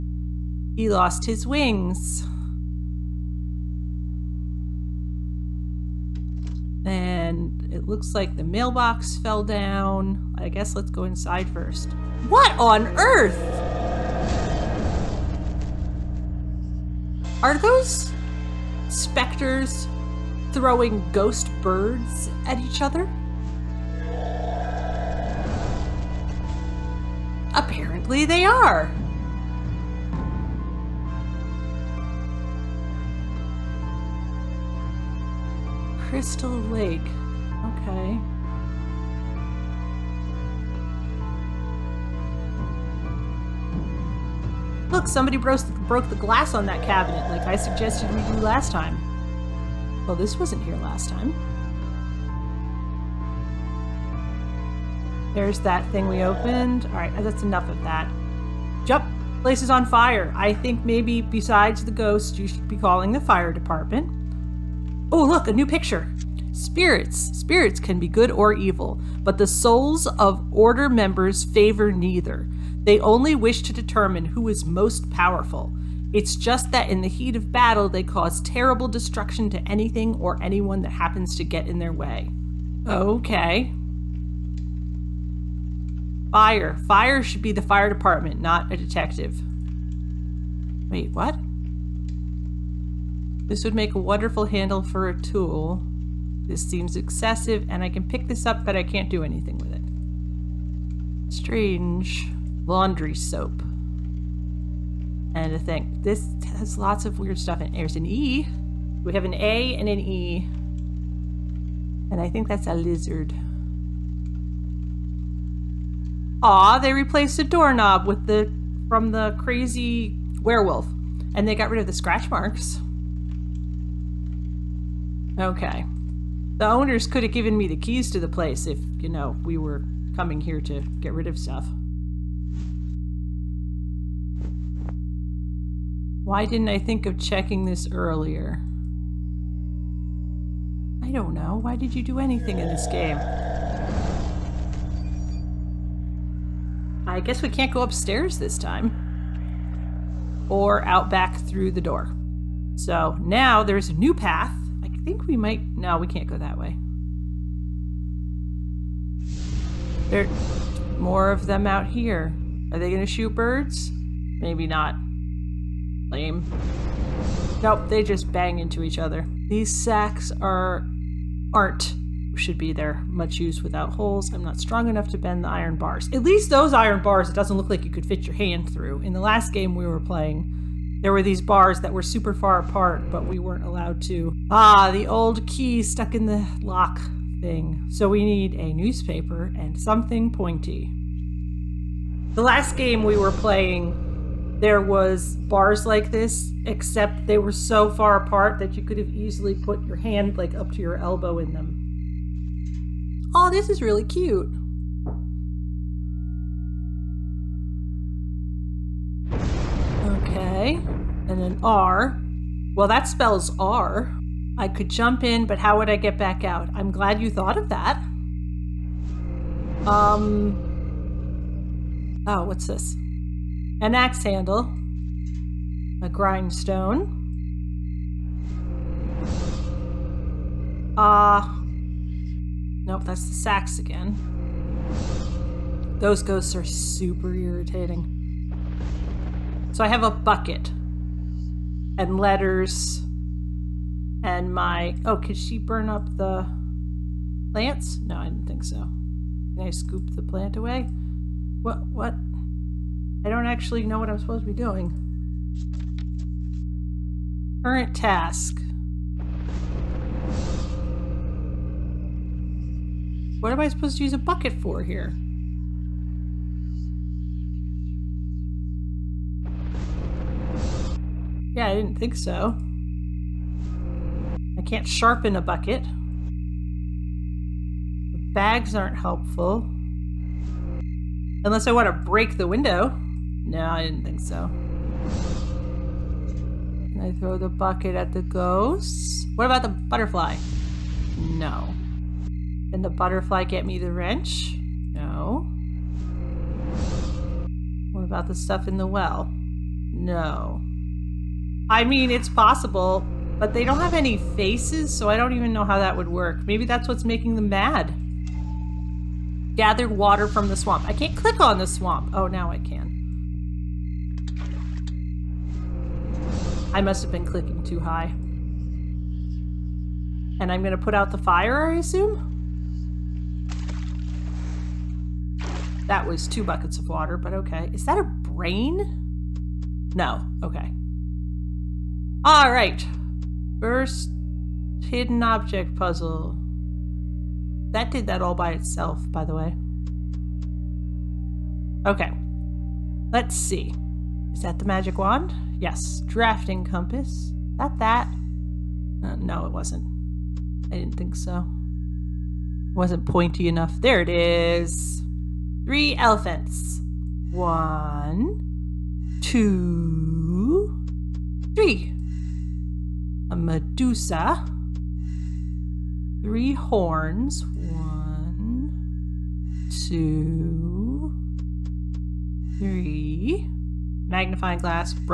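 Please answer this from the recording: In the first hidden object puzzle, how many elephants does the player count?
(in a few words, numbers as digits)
3.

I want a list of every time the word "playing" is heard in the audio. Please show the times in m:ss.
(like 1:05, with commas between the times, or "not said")
3:00, 3:13.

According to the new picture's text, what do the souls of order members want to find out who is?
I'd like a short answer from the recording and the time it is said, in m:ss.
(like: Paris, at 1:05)
Most powerful, at 1:14.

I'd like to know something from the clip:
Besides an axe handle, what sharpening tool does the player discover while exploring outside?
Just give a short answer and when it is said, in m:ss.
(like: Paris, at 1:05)
A grindstone, at 3:46.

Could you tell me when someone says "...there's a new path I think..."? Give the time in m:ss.
2:33.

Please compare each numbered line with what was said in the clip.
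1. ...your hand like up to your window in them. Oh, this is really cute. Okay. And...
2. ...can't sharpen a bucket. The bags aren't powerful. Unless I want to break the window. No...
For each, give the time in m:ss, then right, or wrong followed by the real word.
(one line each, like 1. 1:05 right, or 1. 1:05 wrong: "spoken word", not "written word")
1. 3:19 wrong: "elbow", not "window"
2. 4:34 wrong: "helpful", not "powerful".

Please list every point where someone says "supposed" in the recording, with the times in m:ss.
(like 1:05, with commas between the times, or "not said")
4:14, 4:23.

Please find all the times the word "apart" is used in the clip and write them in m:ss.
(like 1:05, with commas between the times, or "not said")
3:02, 3:18.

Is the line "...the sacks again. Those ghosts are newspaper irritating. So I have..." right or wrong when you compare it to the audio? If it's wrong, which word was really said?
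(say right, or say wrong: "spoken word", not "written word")
wrong: "super", not "newspaper".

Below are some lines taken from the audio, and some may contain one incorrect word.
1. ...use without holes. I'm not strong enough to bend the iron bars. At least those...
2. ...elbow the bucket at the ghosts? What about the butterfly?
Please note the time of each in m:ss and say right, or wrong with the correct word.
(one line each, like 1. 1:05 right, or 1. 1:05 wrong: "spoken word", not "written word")
1. 2:53 right
2. 4:47 wrong: "throw", not "elbow".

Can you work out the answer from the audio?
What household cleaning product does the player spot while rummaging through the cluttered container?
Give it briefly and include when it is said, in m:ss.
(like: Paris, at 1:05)
Laundry soap, at 1:42.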